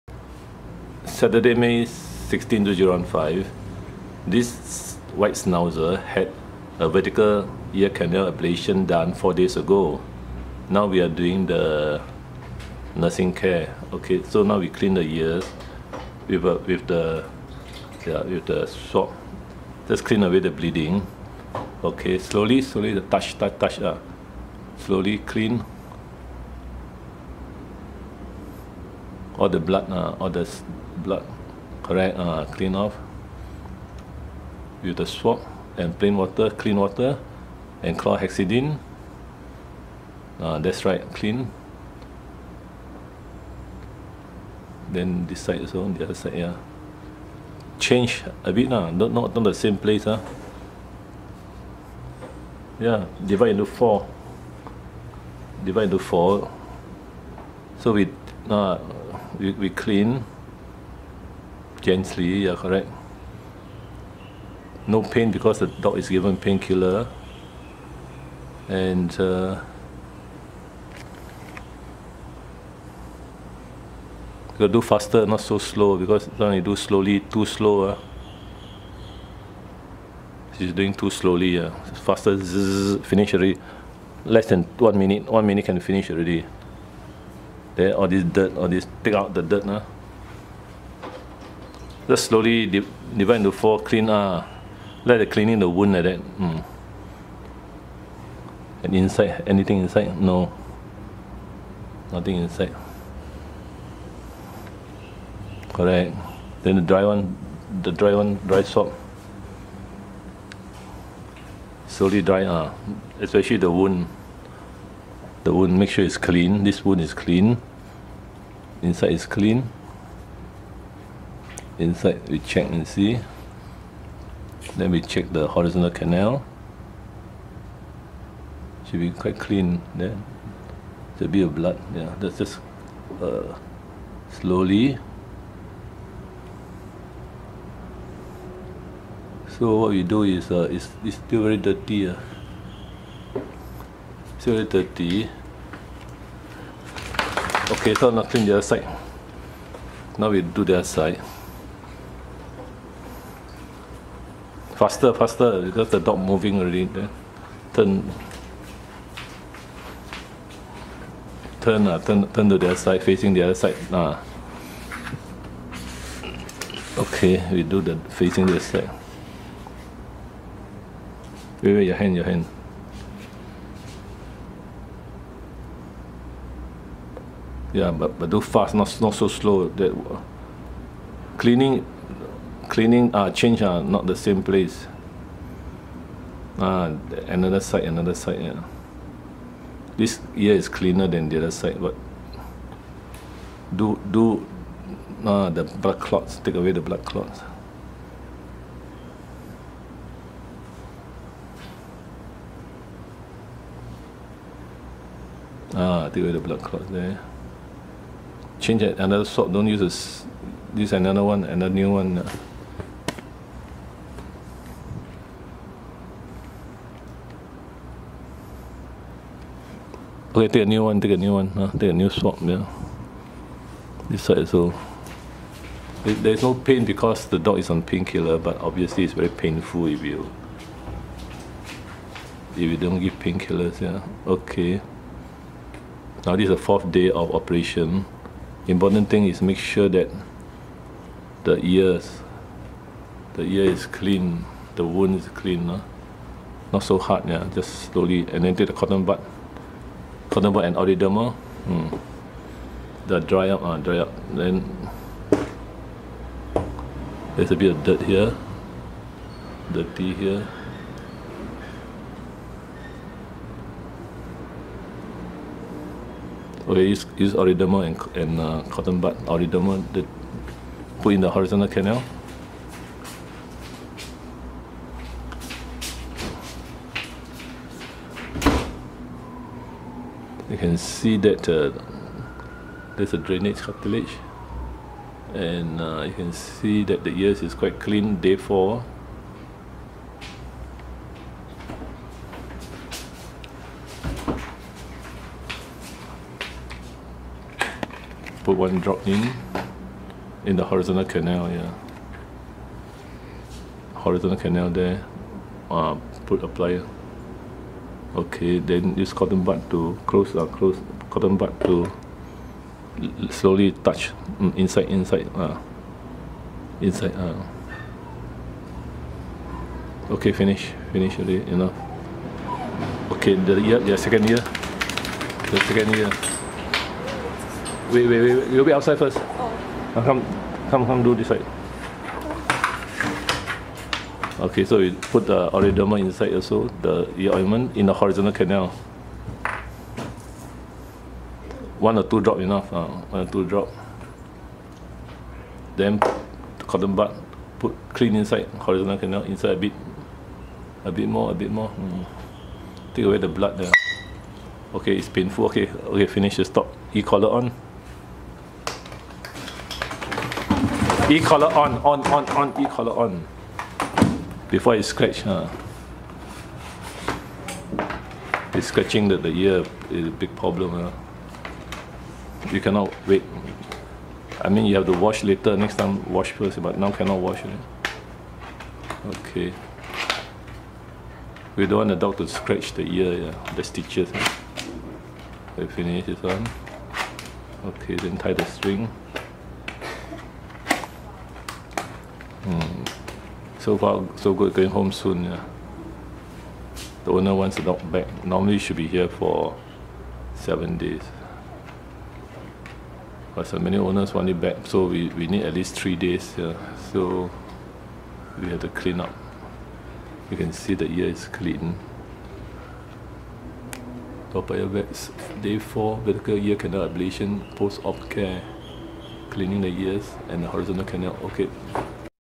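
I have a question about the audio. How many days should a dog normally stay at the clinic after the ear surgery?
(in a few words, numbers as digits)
7.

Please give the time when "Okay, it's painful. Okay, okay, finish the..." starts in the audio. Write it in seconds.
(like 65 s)
354 s.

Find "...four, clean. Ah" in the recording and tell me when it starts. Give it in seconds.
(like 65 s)
93 s.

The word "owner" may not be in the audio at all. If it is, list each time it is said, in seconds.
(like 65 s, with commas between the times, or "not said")
397 s, 403 s.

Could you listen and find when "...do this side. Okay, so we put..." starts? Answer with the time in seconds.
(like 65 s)
331 s.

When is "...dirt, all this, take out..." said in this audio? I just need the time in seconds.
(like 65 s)
88 s.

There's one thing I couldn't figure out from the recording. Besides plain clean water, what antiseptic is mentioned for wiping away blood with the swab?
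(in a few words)
Chlorhexidine.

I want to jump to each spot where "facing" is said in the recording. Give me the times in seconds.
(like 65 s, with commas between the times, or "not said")
163 s, 168 s.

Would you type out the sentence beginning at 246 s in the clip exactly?
not so hard, yeah, just slowly, and then take the cotton bud, cotton bud and ododermal, mm.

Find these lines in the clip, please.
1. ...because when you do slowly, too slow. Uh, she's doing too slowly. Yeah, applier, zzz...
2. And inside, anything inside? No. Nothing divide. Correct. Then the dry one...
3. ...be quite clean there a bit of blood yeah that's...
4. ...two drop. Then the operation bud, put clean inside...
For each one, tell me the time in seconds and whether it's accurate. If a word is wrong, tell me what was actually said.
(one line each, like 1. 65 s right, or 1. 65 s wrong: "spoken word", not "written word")
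1. 75 s wrong: "faster", not "applier"
2. 98 s wrong: "inside", not "divide"
3. 128 s right
4. 343 s wrong: "cotton", not "operation".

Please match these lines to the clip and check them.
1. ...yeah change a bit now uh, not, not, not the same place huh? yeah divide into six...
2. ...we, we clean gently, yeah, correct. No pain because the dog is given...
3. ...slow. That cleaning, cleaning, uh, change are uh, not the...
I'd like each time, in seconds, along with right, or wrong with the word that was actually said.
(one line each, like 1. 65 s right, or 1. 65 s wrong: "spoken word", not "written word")
1. 46 s wrong: "four", not "six"
2. 59 s right
3. 179 s right.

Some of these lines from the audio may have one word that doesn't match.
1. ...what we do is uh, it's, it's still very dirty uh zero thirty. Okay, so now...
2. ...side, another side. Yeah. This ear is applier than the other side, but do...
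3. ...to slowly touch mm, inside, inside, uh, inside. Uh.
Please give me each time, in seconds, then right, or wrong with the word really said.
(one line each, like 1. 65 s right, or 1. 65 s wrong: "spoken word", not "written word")
1. 139 s right
2. 187 s wrong: "cleaner", not "applier"
3. 311 s right.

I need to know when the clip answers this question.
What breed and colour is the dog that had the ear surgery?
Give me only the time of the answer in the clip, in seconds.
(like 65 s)
5 s.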